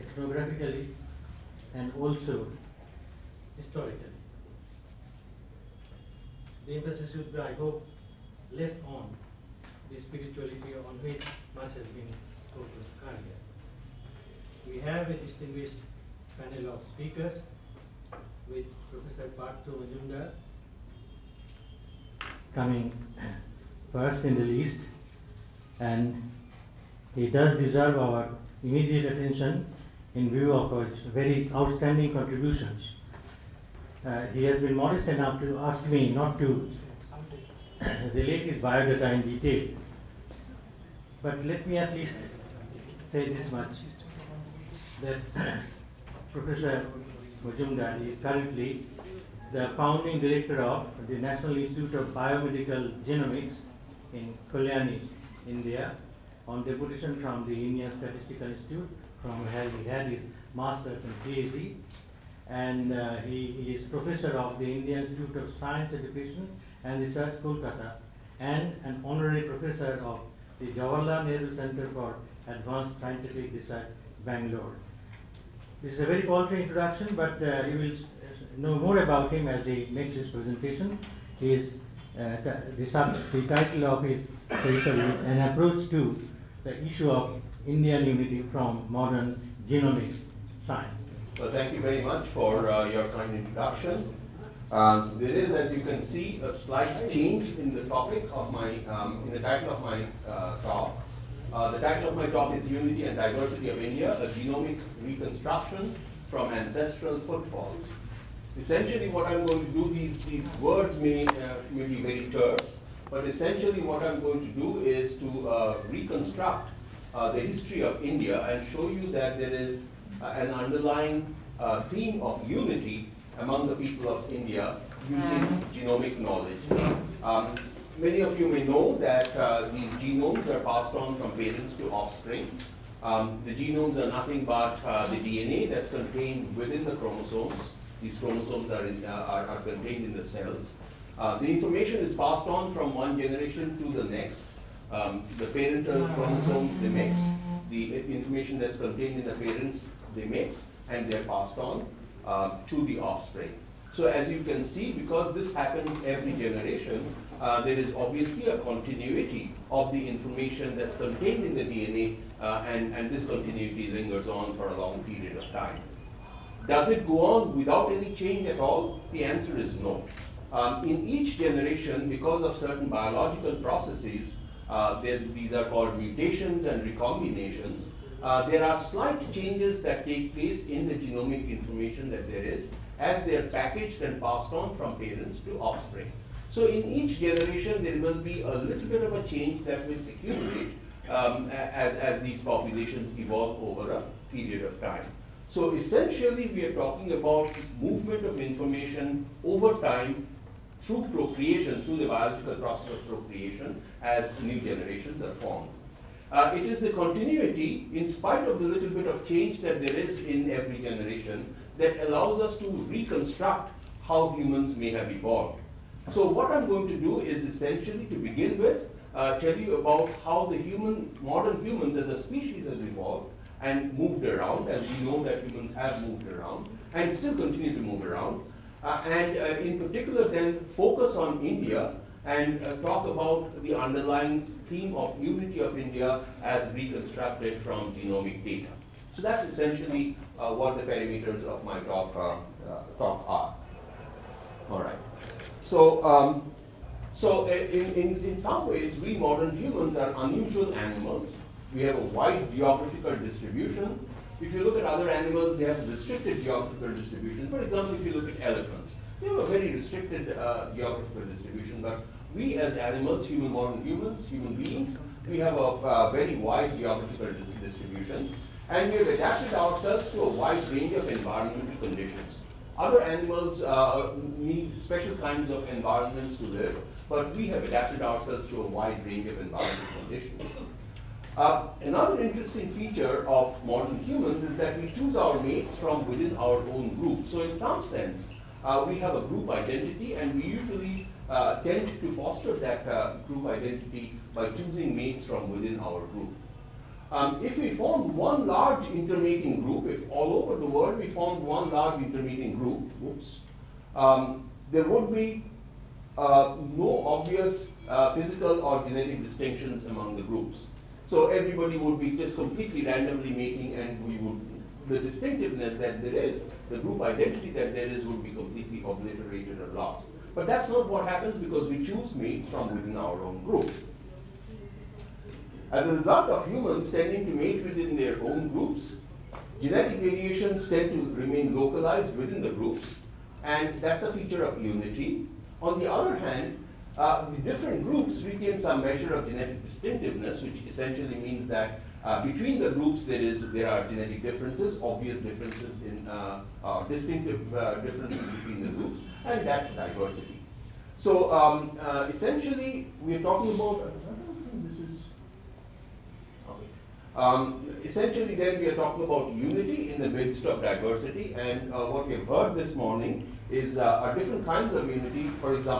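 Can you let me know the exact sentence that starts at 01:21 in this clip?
is, uh, the, sub, the title of his paper is An Approach to the Issue of Indian Unity from Modern Genomic Science.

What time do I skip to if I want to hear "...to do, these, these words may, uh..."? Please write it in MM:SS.
01:49.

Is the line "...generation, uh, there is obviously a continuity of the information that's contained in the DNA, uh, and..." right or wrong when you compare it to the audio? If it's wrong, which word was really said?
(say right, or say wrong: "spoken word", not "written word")
right.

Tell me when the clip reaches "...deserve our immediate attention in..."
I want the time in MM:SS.
00:27.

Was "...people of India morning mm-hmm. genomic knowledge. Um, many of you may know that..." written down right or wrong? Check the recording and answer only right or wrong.
wrong.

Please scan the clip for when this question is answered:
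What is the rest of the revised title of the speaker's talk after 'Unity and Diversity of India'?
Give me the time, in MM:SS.
01:44.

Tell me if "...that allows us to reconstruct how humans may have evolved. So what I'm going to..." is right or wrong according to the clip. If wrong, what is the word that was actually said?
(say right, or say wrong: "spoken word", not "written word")
right.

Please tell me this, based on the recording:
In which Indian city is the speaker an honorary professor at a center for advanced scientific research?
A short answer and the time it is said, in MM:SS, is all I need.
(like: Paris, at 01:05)
Bangalore, at 01:14.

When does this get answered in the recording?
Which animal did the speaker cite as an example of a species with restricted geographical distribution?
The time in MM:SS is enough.
04:18.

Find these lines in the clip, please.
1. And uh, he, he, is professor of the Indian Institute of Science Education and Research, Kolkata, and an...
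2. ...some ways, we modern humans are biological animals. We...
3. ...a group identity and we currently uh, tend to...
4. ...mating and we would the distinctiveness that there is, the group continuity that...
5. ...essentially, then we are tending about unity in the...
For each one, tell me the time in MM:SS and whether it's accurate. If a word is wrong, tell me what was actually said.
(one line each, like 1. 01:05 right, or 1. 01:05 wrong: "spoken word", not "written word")
1. 01:02 right
2. 04:08 wrong: "unusual", not "biological"
3. 04:49 wrong: "usually", not "currently"
4. 05:13 wrong: "identity", not "continuity"
5. 05:57 wrong: "talking", not "tending".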